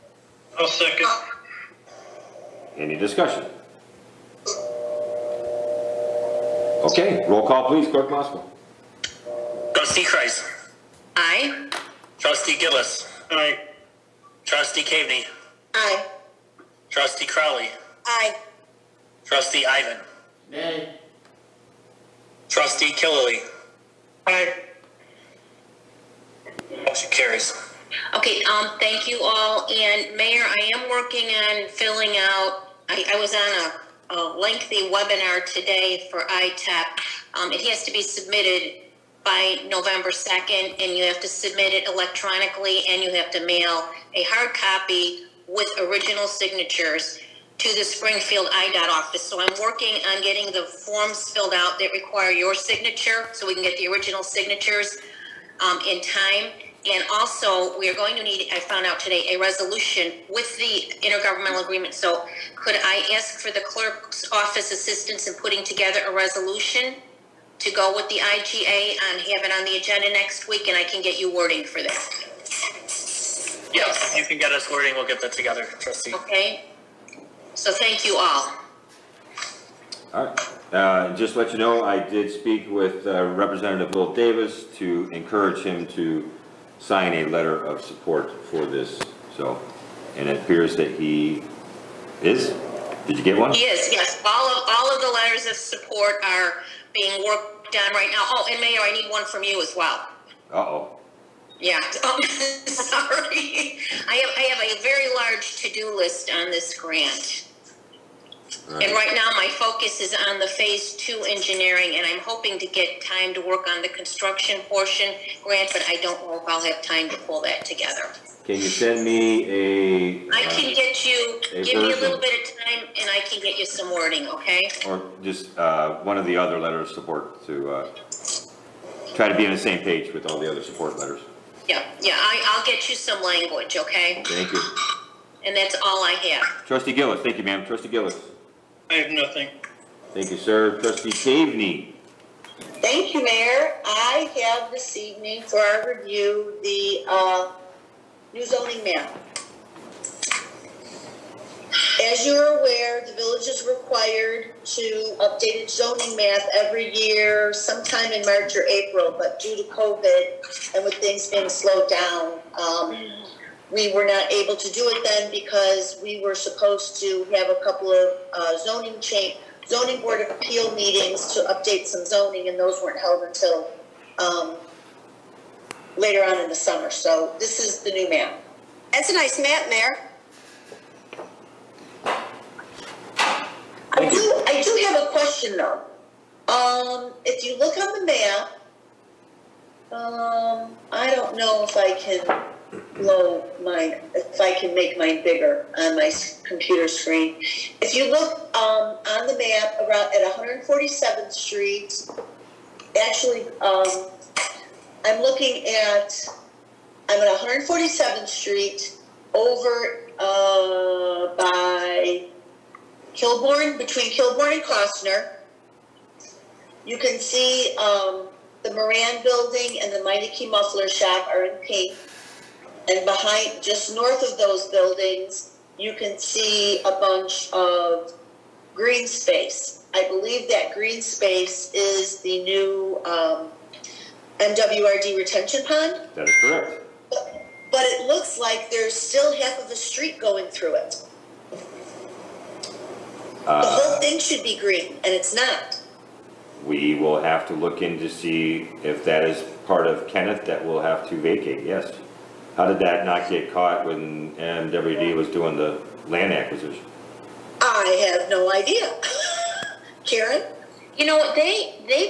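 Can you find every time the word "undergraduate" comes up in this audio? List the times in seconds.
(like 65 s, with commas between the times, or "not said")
not said.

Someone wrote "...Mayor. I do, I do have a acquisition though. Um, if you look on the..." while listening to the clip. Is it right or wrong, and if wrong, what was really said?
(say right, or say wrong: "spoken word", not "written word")
wrong: "question", not "acquisition".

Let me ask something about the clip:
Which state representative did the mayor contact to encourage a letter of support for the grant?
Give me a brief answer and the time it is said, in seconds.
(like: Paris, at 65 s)
Will Davis, at 83 s.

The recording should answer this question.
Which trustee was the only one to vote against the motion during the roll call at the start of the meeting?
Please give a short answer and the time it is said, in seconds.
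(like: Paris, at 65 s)
Ivan, at 19 s.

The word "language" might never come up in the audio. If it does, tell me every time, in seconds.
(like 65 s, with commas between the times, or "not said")
133 s.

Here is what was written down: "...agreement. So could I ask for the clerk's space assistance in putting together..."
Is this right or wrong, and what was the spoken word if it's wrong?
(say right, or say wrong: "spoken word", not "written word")
wrong: "office", not "space".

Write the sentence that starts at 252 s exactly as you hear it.
How did that not get caught when MWD was doing the land acquisition?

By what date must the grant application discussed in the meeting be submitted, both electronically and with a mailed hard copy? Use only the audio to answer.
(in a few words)
November 2nd.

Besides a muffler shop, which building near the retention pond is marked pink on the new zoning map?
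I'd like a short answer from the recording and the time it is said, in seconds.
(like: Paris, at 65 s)
Moran Building, at 218 s.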